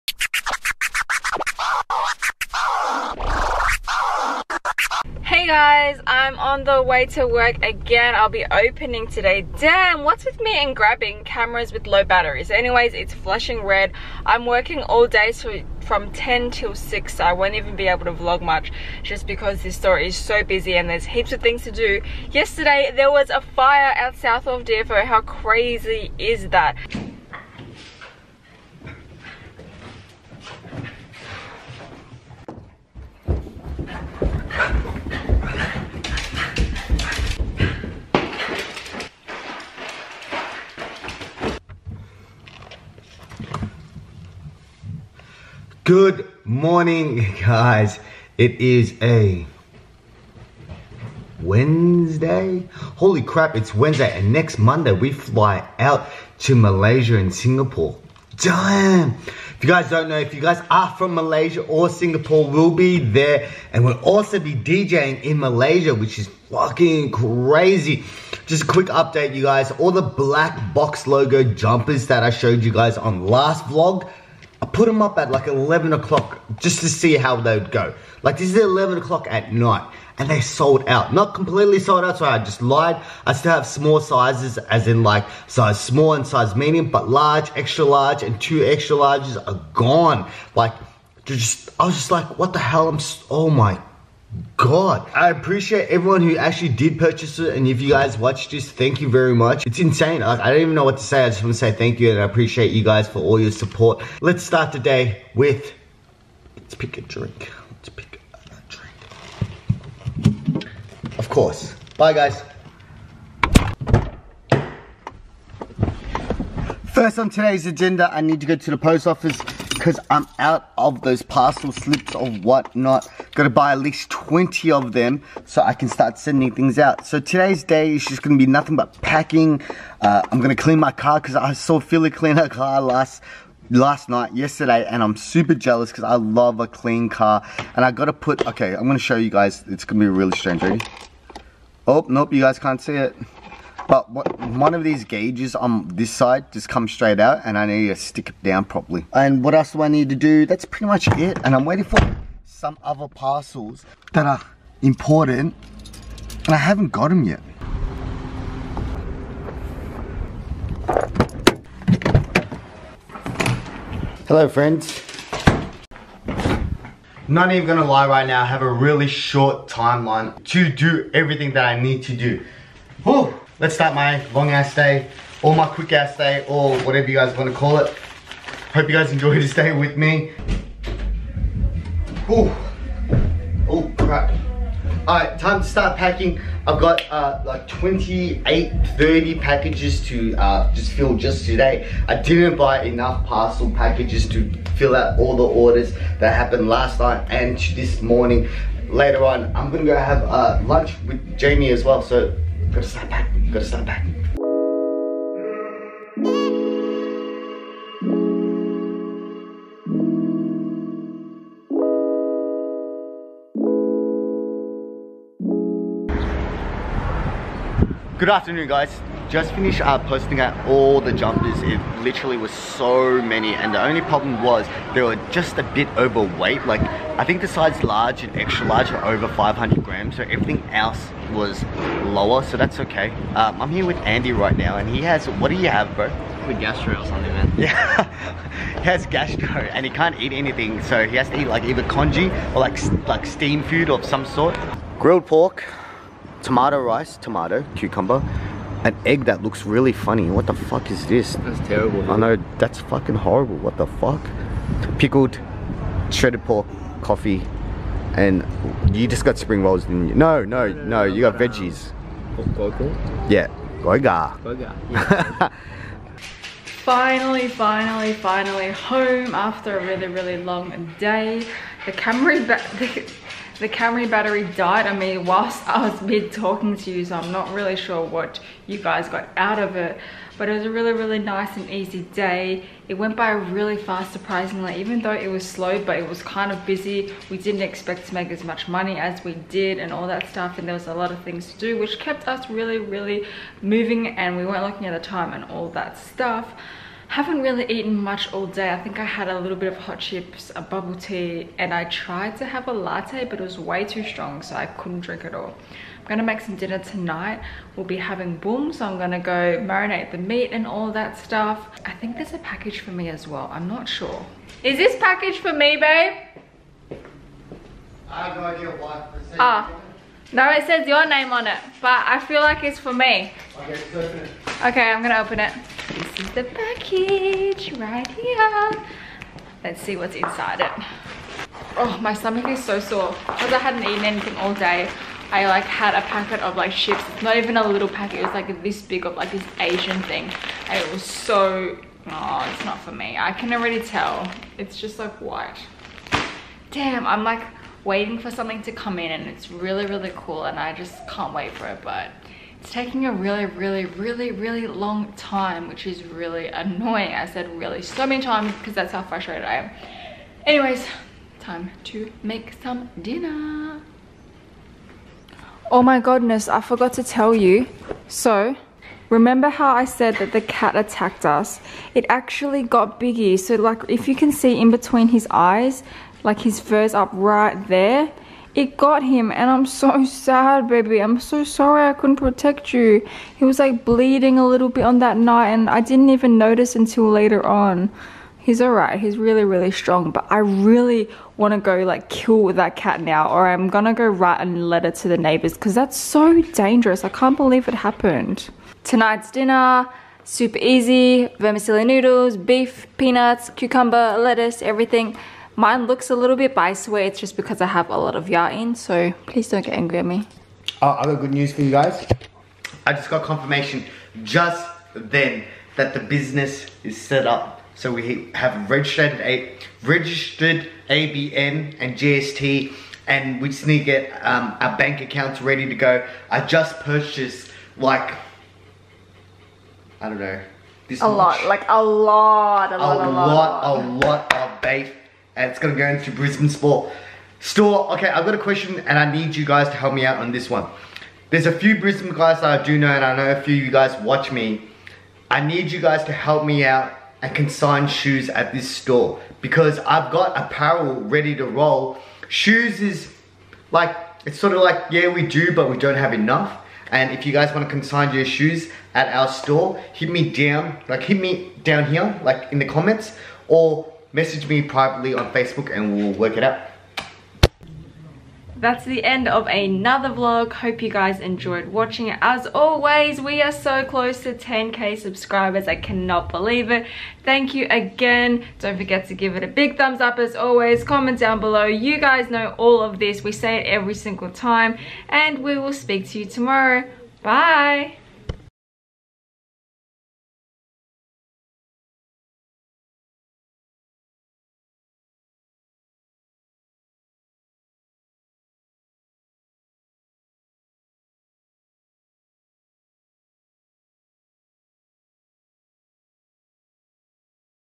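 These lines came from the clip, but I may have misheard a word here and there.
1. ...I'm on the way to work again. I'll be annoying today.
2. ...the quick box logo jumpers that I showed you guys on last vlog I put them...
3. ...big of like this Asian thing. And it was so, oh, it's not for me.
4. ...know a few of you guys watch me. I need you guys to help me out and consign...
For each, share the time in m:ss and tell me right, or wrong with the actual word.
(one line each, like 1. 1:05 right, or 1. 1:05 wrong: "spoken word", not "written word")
1. 0:06 wrong: "opening", not "annoying"
2. 1:09 wrong: "black", not "quick"
3. 5:38 right
4. 7:23 right.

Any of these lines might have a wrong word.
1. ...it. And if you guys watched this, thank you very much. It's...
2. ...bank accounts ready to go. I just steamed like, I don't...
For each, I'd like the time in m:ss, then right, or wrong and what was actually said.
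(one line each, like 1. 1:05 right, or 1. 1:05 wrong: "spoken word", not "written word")
1. 1:37 right
2. 7:04 wrong: "purchased", not "steamed".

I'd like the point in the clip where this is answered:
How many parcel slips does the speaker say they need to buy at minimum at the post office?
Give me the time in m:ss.
2:04.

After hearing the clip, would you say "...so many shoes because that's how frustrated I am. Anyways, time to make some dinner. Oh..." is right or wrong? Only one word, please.
wrong.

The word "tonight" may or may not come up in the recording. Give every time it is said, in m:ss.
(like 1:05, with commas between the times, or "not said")
5:06, 6:38.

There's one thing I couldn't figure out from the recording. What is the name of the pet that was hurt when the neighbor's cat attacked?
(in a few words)
Biggie.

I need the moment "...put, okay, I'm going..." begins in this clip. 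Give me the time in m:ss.
2:18.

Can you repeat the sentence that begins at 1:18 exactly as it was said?
Like this is 11 o'clock at night and they sold out.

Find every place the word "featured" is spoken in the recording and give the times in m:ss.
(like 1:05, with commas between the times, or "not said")
not said.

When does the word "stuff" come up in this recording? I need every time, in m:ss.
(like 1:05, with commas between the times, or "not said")
4:50, 4:55, 5:11.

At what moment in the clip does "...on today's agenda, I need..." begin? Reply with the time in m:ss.
1:57.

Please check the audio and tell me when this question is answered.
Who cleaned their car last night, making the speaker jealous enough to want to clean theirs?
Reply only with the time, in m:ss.
2:11.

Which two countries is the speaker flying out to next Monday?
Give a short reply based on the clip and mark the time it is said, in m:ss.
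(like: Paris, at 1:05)
Malaysia and Singapore, at 0:56.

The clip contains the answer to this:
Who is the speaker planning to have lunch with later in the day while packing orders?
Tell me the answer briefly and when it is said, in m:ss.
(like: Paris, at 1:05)
Jamie, at 3:21.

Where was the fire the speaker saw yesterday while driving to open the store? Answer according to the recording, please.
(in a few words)
South of DFO.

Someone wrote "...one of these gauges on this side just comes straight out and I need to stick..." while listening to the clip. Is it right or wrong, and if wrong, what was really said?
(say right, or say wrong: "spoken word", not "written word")
right.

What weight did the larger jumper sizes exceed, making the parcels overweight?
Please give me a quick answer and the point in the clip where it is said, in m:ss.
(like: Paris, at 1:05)
500 grams, at 3:49.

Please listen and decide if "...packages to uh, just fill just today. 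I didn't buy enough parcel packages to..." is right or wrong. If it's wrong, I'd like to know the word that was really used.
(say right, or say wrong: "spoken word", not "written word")
right.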